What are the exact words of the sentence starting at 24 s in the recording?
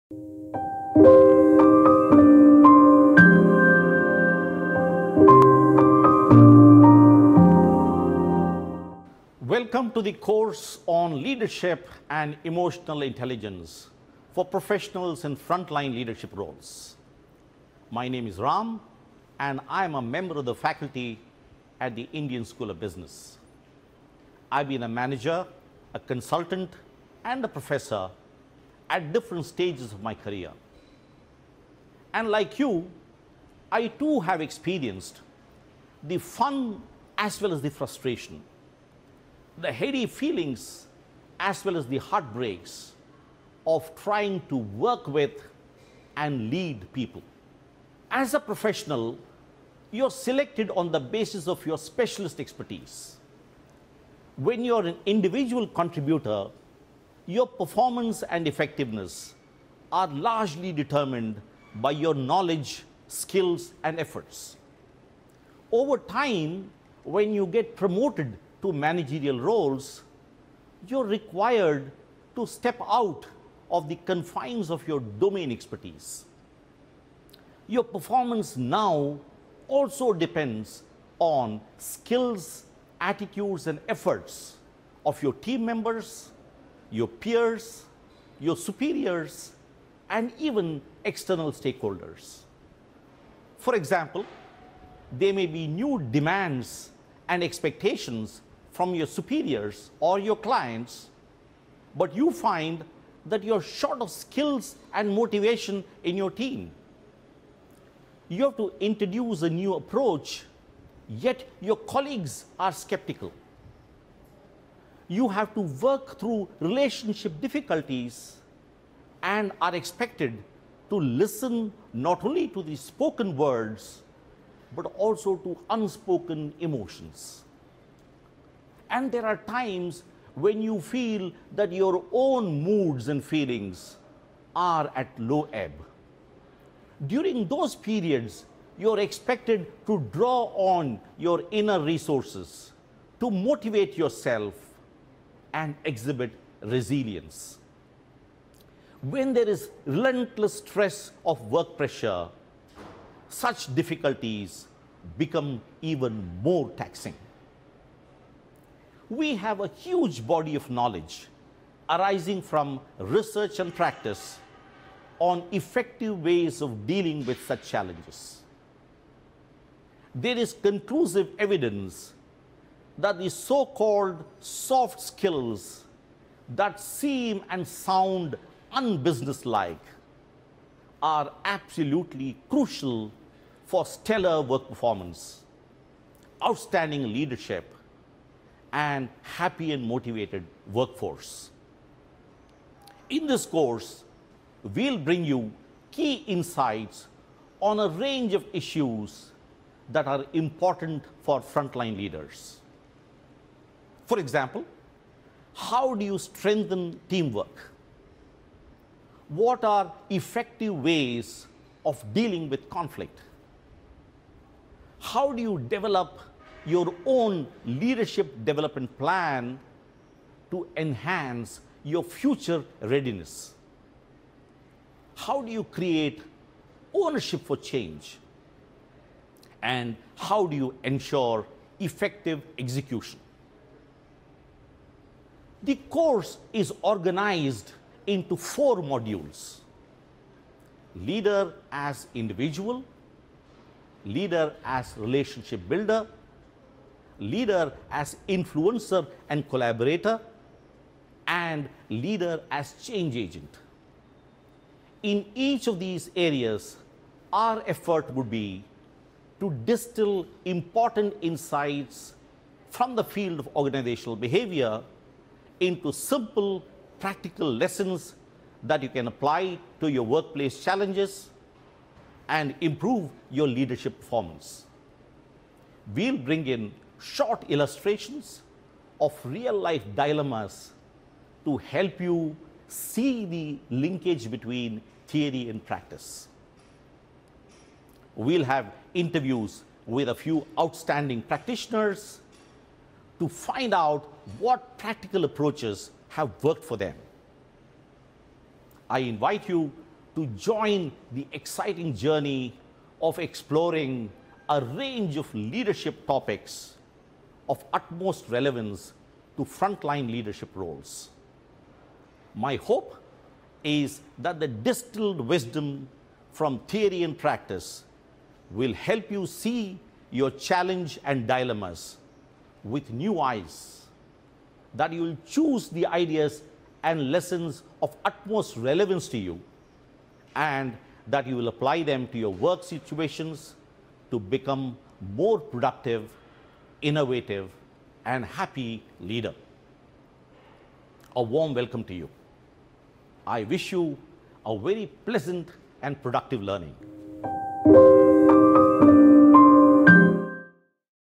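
I've been a manager, a consultant and a professor at different stages of my career.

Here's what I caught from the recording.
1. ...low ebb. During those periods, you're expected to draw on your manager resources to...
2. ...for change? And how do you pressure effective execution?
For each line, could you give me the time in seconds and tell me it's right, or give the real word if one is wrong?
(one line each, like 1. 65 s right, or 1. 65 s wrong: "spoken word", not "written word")
1. 135 s wrong: "inner", not "manager"
2. 227 s wrong: "ensure", not "pressure".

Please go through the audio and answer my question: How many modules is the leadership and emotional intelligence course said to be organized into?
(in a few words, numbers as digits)
4.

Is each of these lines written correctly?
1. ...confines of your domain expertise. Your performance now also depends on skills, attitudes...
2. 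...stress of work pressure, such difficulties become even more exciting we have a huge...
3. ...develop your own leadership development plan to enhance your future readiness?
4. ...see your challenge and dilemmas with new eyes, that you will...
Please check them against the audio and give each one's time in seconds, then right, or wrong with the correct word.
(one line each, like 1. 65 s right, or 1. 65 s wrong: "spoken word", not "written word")
1. 73 s right
2. 150 s wrong: "taxing", not "exciting"
3. 215 s right
4. 319 s right.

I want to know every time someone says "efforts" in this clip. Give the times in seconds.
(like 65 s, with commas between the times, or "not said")
63 s, 83 s, 257 s.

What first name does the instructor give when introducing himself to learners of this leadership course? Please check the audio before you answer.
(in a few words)
Ram.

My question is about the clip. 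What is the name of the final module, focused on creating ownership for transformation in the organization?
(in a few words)
Leader as change agent.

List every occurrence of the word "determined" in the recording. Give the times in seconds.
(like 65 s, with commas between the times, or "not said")
60 s.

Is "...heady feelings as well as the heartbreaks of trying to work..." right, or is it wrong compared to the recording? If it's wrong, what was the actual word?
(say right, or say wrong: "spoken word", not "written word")
right.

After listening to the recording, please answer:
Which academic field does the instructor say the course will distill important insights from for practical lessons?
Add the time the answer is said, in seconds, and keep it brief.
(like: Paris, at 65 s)
Organizational behavior, at 263 s.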